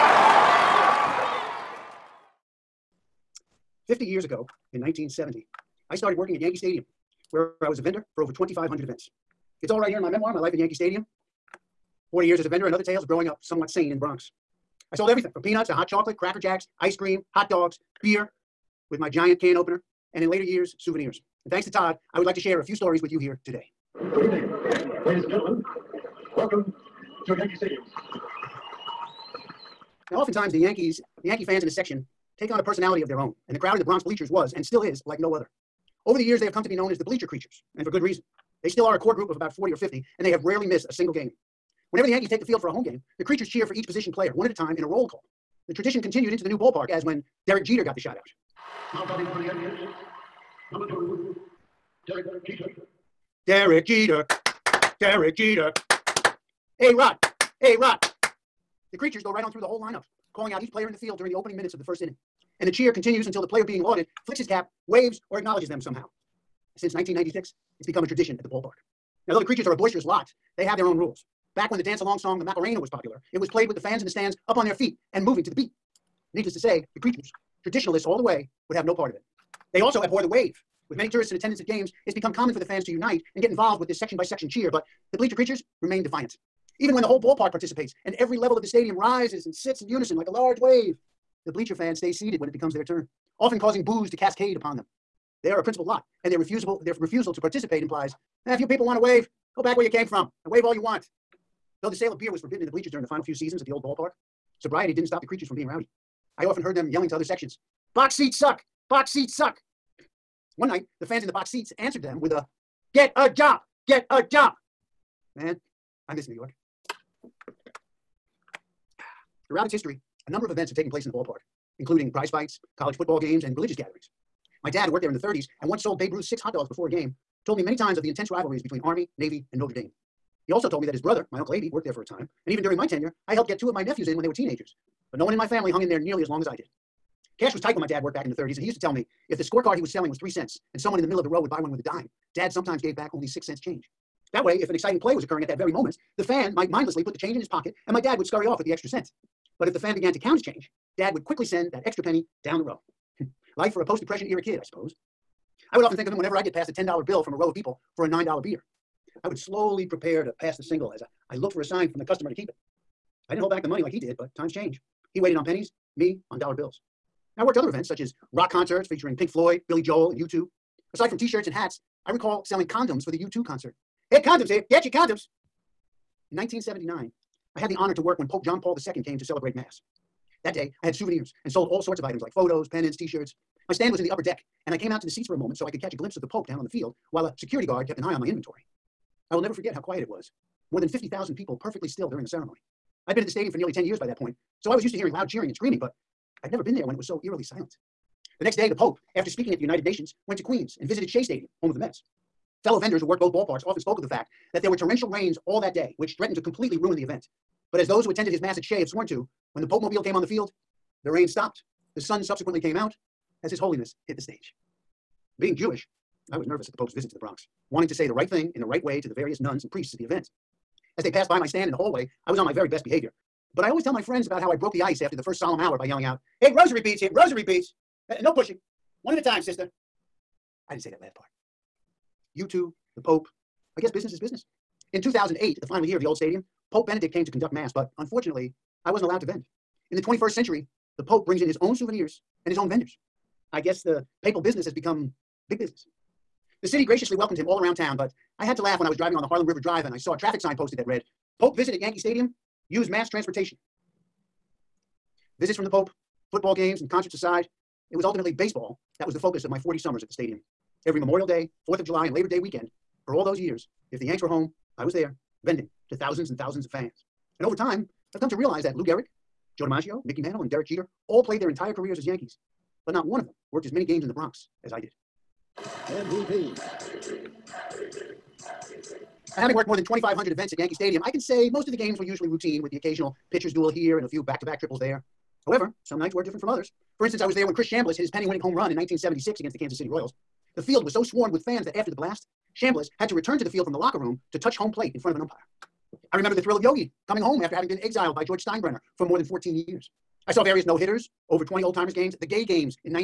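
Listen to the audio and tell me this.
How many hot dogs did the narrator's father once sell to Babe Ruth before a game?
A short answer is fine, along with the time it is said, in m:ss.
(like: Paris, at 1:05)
6, at 2:06.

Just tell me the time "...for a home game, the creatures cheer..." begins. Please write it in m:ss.
0:42.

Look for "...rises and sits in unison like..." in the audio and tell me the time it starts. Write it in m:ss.
1:28.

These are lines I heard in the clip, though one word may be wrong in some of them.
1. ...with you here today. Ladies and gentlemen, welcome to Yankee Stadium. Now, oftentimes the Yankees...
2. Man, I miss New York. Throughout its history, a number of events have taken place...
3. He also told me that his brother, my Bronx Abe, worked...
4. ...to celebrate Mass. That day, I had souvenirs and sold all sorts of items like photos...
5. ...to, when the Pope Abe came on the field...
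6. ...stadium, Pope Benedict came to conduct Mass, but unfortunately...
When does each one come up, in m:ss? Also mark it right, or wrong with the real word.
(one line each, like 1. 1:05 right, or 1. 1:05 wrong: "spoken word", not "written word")
1. 0:23 right
2. 1:55 right
3. 2:10 wrong: "Uncle", not "Bronx"
4. 2:59 right
5. 3:29 wrong: "Mobile", not "Abe"
6. 3:56 right.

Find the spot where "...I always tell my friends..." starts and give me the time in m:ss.
3:43.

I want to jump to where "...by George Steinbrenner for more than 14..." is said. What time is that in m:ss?
4:58.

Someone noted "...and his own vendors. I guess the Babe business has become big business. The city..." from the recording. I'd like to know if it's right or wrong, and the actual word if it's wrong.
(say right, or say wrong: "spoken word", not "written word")
wrong: "Papal", not "Babe".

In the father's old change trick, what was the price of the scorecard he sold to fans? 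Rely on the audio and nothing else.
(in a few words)
3 cents.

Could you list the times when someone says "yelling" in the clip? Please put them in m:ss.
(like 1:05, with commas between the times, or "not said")
1:46, 3:45.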